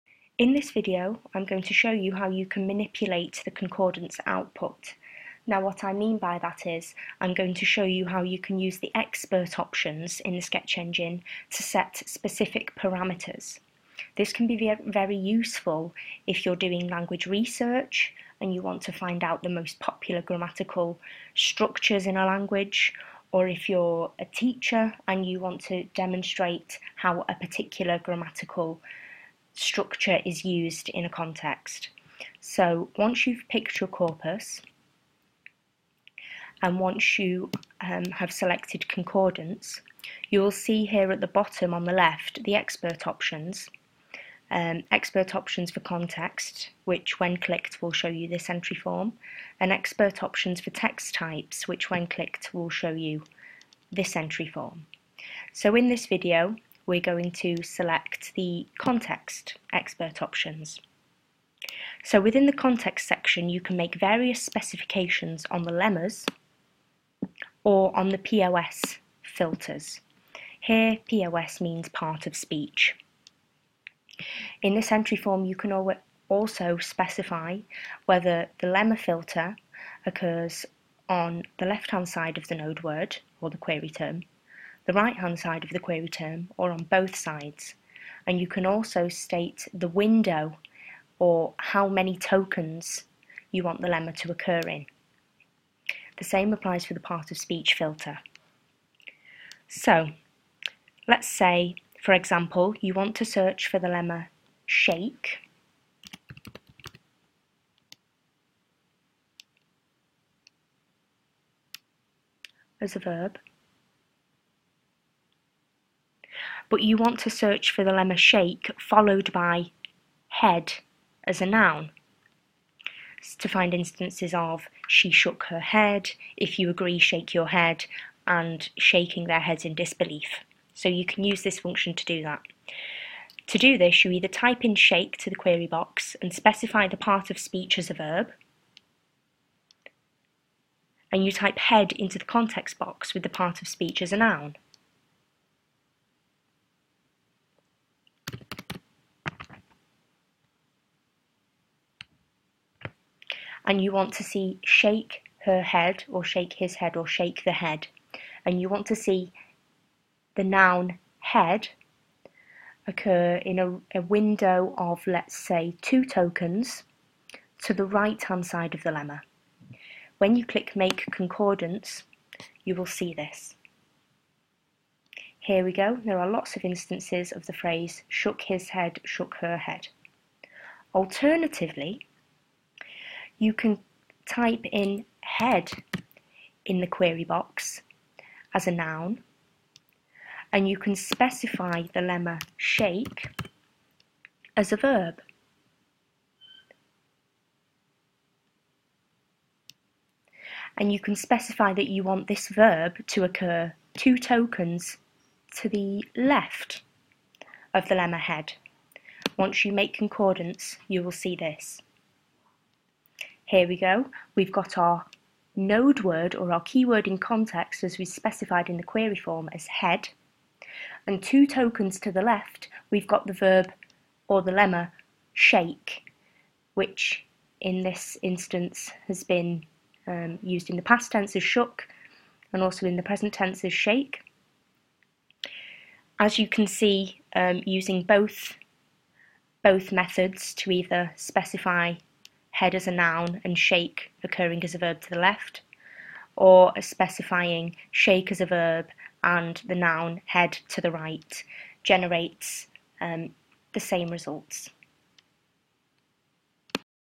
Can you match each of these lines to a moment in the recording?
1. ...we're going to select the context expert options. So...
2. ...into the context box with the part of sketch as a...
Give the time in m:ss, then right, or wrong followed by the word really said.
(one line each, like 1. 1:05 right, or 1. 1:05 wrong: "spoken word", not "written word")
1. 0:56 right
2. 2:21 wrong: "speech", not "sketch".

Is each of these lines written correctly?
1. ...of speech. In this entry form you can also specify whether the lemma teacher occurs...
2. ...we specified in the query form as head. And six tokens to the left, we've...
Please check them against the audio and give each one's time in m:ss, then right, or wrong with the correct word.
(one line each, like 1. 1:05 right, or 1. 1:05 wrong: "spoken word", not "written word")
1. 1:12 wrong: "filter", not "teacher"
2. 3:37 wrong: "two", not "six".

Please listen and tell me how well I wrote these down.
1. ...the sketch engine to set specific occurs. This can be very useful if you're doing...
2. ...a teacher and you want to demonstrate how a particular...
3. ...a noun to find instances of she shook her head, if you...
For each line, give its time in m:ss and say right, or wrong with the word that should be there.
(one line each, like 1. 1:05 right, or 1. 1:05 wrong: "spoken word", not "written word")
1. 0:10 wrong: "parameters", not "occurs"
2. 0:24 right
3. 2:01 right.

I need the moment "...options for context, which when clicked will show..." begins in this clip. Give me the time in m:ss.
0:45.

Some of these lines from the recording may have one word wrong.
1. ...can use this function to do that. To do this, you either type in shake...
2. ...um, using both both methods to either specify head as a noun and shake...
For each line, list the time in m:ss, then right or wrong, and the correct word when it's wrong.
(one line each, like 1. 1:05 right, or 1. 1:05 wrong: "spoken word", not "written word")
1. 2:11 right
2. 3:57 right.